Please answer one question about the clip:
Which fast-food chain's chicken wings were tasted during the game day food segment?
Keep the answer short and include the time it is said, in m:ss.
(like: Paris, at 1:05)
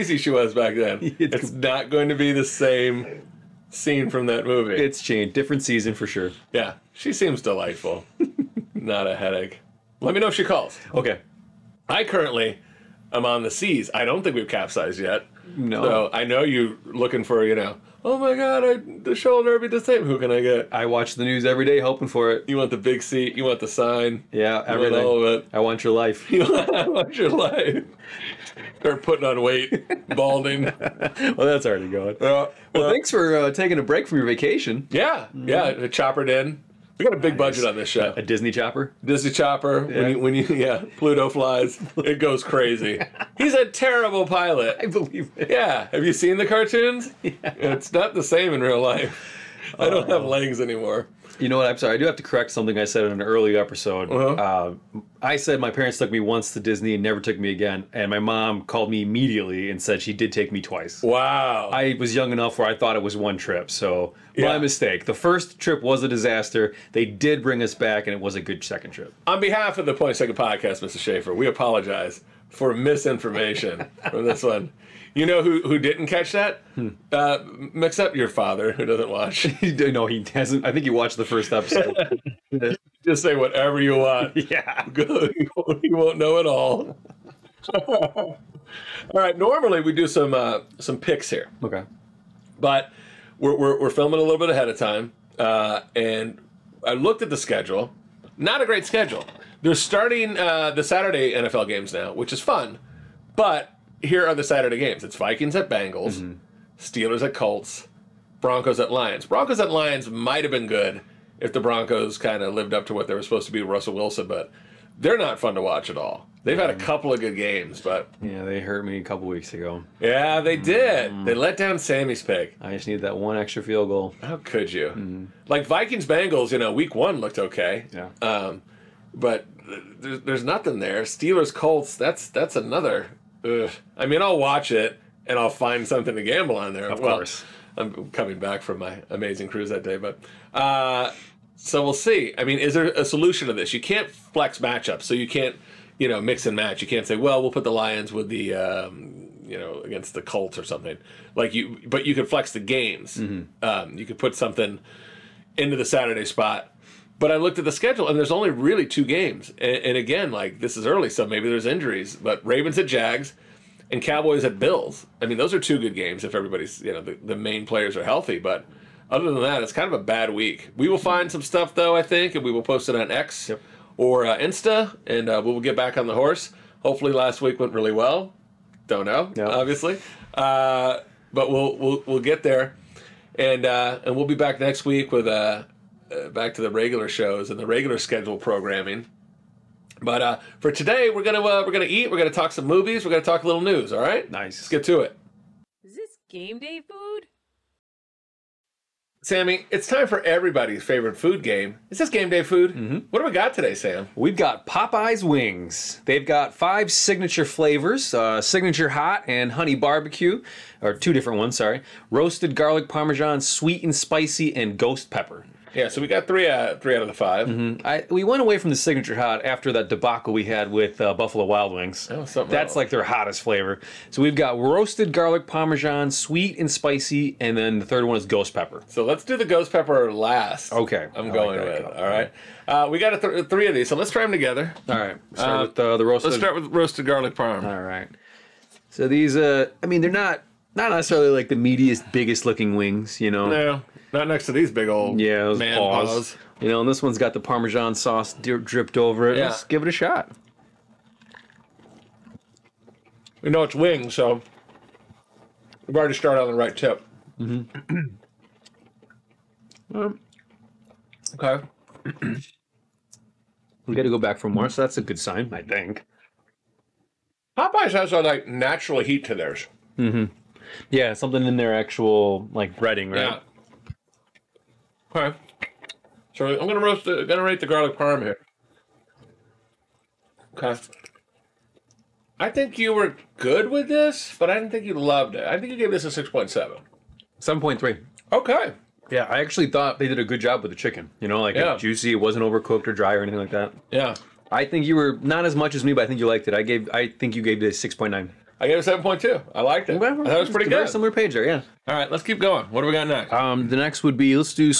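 Popeyes, at 3:24.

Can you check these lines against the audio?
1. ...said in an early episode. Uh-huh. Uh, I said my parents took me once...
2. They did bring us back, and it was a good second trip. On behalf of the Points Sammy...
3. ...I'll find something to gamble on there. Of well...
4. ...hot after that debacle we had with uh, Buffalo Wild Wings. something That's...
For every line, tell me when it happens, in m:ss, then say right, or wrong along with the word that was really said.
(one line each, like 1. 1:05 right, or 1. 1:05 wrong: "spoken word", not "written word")
1. 0:52 right
2. 1:06 wrong: "Taken", not "Sammy"
3. 2:15 right
4. 3:39 right.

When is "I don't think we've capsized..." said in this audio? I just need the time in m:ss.
0:13.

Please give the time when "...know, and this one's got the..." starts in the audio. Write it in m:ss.
4:06.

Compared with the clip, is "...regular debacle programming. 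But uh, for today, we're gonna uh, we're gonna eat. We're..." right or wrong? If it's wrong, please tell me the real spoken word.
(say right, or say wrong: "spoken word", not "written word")
wrong: "schedule", not "debacle".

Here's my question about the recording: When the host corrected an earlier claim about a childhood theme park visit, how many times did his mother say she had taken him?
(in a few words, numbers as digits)
twice.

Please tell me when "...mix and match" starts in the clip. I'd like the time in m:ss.
2:26.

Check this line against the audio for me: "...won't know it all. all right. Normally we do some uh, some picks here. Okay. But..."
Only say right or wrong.
right.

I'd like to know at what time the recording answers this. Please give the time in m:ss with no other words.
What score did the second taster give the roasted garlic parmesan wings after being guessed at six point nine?
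4:58.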